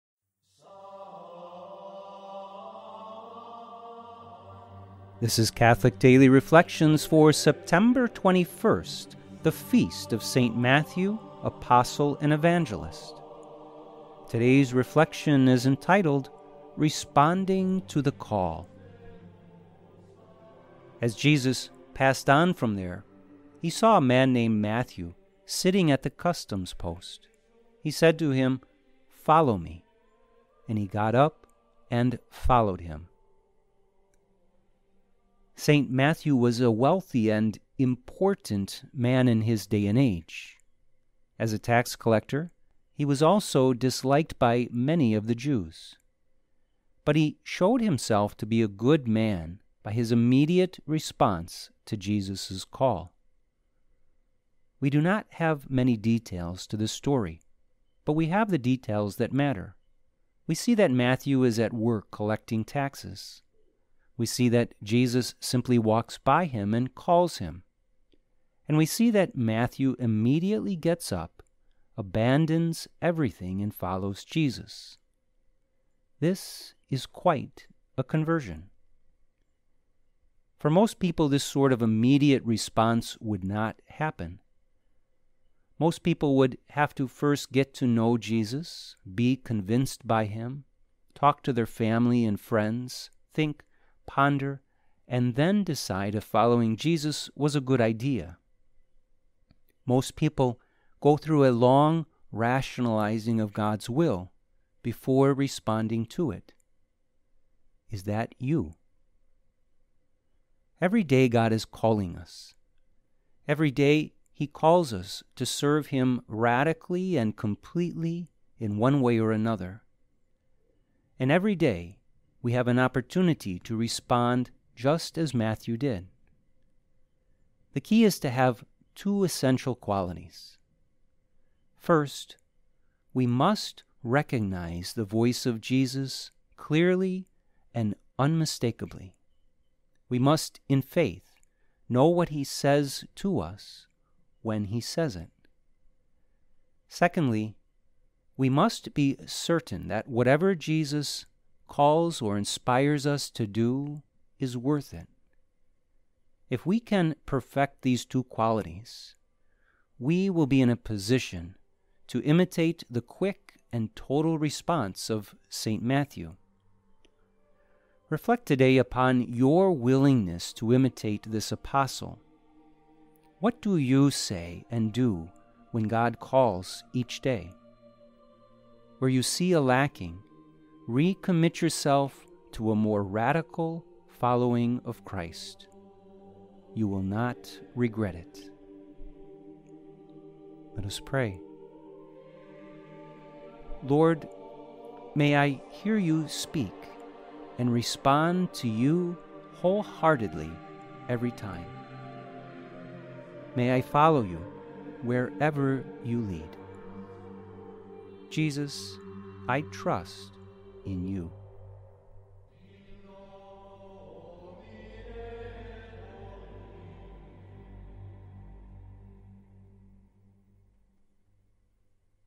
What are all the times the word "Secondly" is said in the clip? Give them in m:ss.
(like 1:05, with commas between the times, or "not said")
2:26.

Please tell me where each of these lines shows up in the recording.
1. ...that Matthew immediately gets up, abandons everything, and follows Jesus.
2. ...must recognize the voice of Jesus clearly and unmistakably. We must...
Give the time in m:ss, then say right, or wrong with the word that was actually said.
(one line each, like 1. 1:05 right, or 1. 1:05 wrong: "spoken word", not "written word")
1. 1:09 right
2. 2:13 right.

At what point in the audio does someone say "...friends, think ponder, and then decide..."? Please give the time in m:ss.
1:32.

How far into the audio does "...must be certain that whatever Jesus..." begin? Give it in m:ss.
2:28.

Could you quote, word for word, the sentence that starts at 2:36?
If we can perfect these two qualities, we will be in a position to imitate the quick and total response of St.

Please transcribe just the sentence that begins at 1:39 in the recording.
Most people go through a long rationalizing of God's will before responding to it.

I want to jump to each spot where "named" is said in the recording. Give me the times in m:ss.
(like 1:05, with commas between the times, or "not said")
0:24.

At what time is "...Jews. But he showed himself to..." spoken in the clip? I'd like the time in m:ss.
0:45.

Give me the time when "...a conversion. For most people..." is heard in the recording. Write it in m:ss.
1:17.